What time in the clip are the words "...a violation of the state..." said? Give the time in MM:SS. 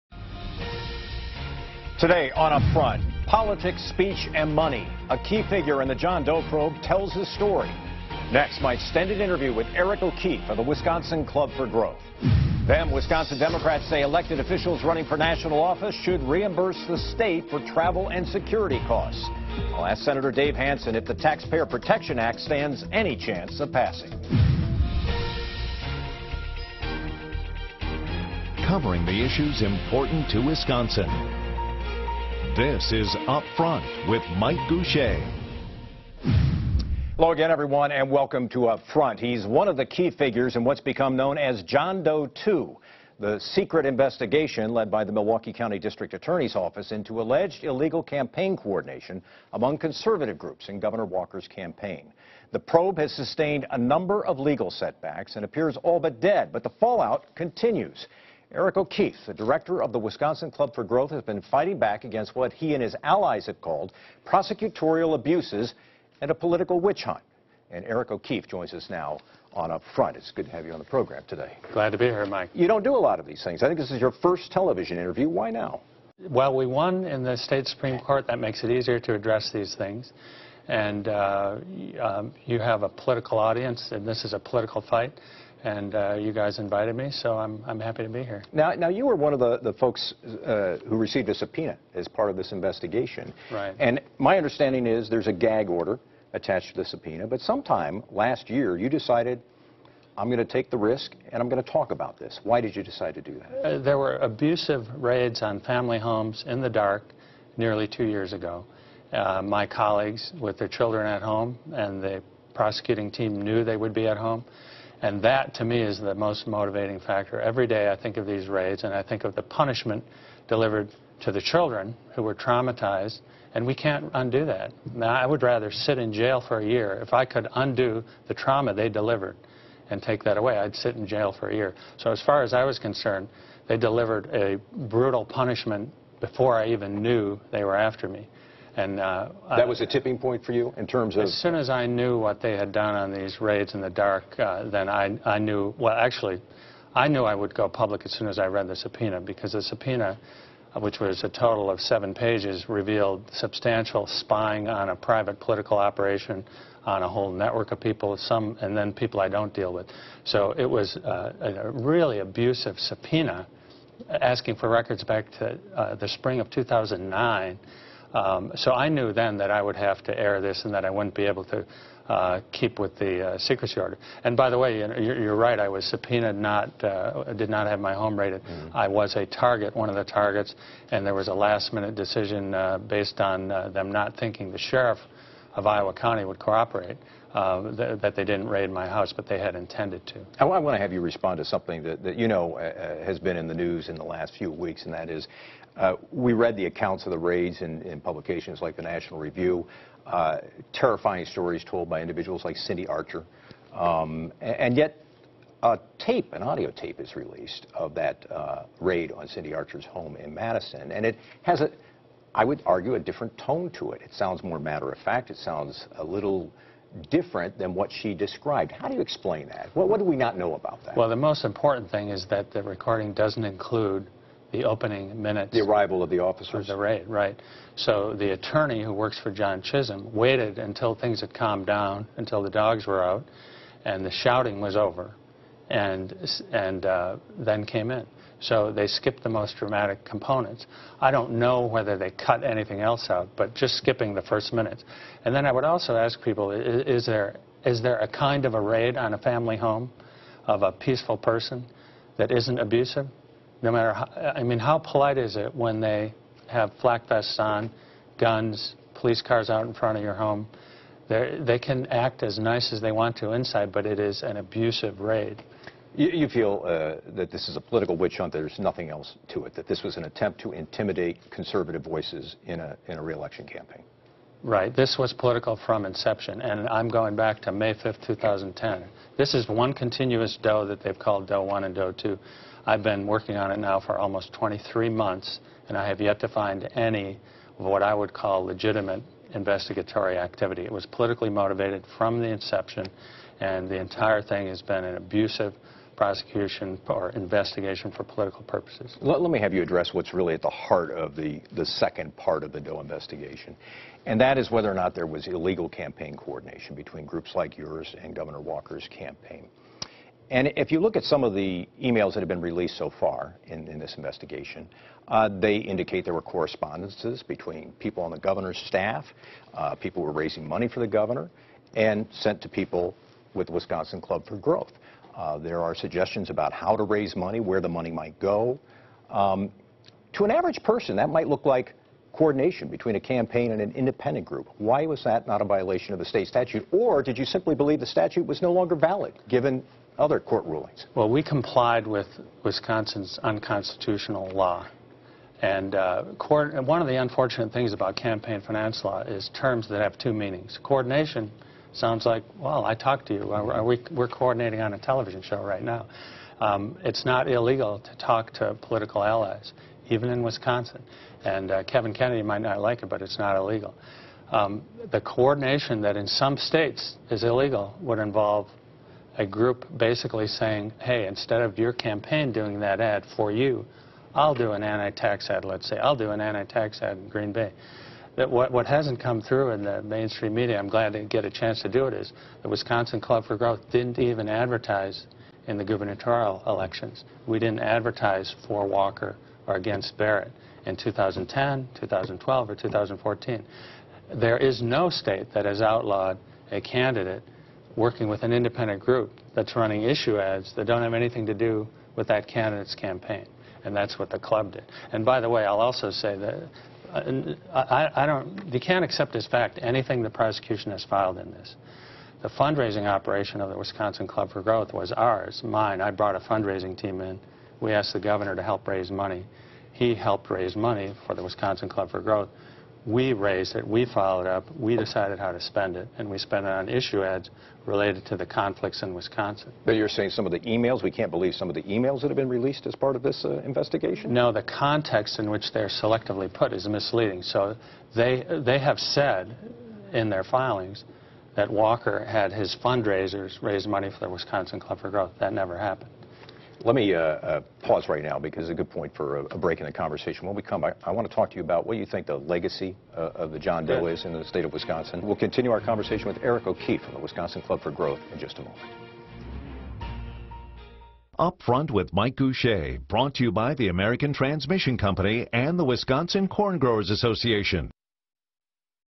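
05:35.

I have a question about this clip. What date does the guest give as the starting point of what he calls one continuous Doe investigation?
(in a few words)
May 5th, 2010.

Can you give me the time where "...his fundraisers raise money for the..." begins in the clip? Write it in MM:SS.
07:22.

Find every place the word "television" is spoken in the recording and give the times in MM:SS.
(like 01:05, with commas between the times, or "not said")
01:14, 05:54.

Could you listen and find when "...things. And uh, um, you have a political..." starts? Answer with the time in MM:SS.
01:19.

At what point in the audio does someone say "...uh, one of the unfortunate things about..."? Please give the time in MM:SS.
05:45.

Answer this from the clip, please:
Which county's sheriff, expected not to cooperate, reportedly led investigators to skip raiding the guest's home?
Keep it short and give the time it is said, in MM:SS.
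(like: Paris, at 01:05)
Iowa County, at 03:05.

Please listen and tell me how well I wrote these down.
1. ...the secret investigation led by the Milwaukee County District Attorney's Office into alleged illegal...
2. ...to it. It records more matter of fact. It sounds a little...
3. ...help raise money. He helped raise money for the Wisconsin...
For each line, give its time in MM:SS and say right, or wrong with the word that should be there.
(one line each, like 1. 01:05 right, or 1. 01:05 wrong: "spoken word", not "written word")
1. 00:43 right
2. 03:33 wrong: "sounds", not "records"
3. 06:58 right.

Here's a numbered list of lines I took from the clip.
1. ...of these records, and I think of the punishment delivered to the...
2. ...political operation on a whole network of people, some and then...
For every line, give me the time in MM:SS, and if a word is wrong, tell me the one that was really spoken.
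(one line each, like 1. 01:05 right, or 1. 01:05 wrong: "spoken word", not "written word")
1. 01:58 wrong: "raids", not "records"
2. 02:35 right.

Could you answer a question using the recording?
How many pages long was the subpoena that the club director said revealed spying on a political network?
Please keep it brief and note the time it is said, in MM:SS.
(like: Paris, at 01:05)
7, at 02:31.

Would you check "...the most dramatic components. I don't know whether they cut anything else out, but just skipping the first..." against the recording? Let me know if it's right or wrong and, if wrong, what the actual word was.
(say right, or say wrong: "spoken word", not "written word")
right.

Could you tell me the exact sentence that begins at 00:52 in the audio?
The probe has sustained a number of legal setbacks and appears all but dead, but the fallout continues.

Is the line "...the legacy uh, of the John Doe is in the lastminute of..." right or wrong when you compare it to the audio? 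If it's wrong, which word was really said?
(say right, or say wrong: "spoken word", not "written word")
wrong: "state", not "lastminute".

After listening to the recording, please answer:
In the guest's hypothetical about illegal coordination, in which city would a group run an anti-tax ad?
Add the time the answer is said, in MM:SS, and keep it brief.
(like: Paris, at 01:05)
Green Bay, at 06:17.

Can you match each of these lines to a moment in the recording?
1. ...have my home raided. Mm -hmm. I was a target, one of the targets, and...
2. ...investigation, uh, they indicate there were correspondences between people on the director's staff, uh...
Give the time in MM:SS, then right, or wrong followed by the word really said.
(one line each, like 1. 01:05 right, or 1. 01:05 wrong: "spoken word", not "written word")
1. 02:57 right
2. 05:13 wrong: "governor", not "director".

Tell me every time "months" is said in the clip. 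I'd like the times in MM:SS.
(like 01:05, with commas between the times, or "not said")
04:44.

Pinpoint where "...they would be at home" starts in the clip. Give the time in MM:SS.
01:53.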